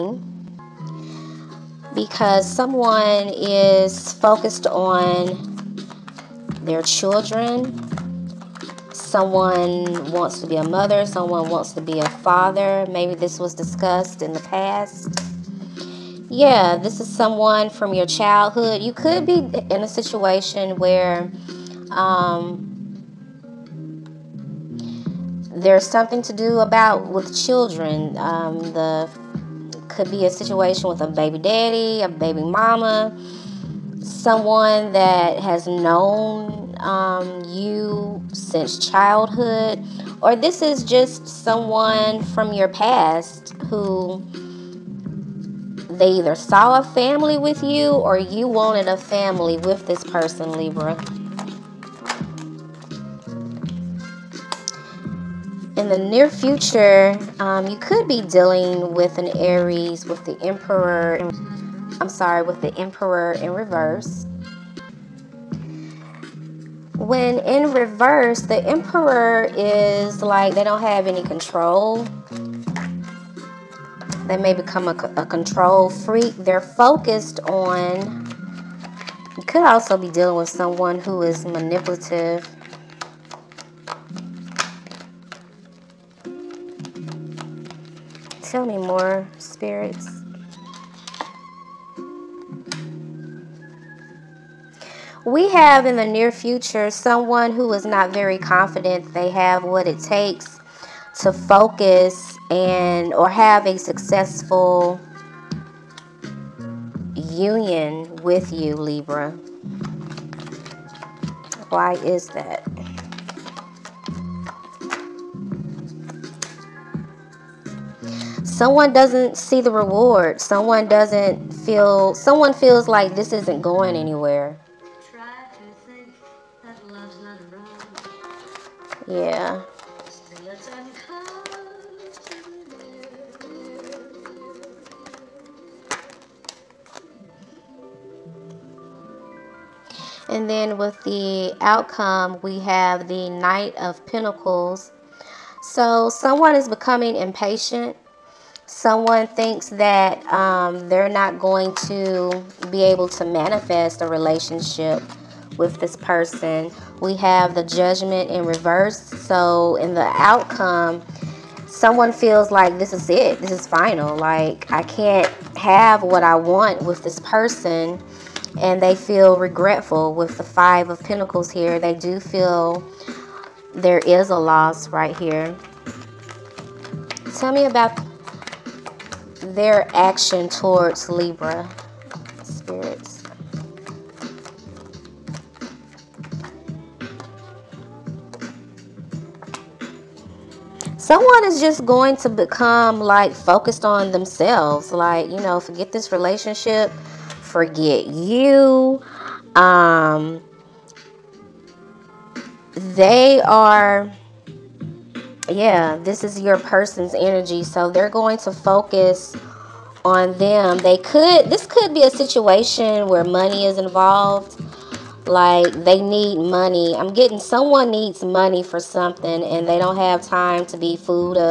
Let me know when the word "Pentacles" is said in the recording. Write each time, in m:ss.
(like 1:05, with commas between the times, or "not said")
2:24, 2:51.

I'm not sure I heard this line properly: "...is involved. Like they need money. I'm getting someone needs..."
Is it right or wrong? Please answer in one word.
right.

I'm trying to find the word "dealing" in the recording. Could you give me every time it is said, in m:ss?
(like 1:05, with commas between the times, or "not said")
0:58, 1:20.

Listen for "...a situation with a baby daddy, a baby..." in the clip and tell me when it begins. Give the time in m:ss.
0:30.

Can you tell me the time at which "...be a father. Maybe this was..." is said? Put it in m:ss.
0:11.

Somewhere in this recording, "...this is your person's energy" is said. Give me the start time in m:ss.
3:26.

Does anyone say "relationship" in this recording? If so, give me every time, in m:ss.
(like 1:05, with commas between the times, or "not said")
2:34, 3:16.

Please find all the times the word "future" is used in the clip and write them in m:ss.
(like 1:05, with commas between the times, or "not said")
0:56, 1:36.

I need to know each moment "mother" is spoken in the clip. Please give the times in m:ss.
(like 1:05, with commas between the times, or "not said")
0:10.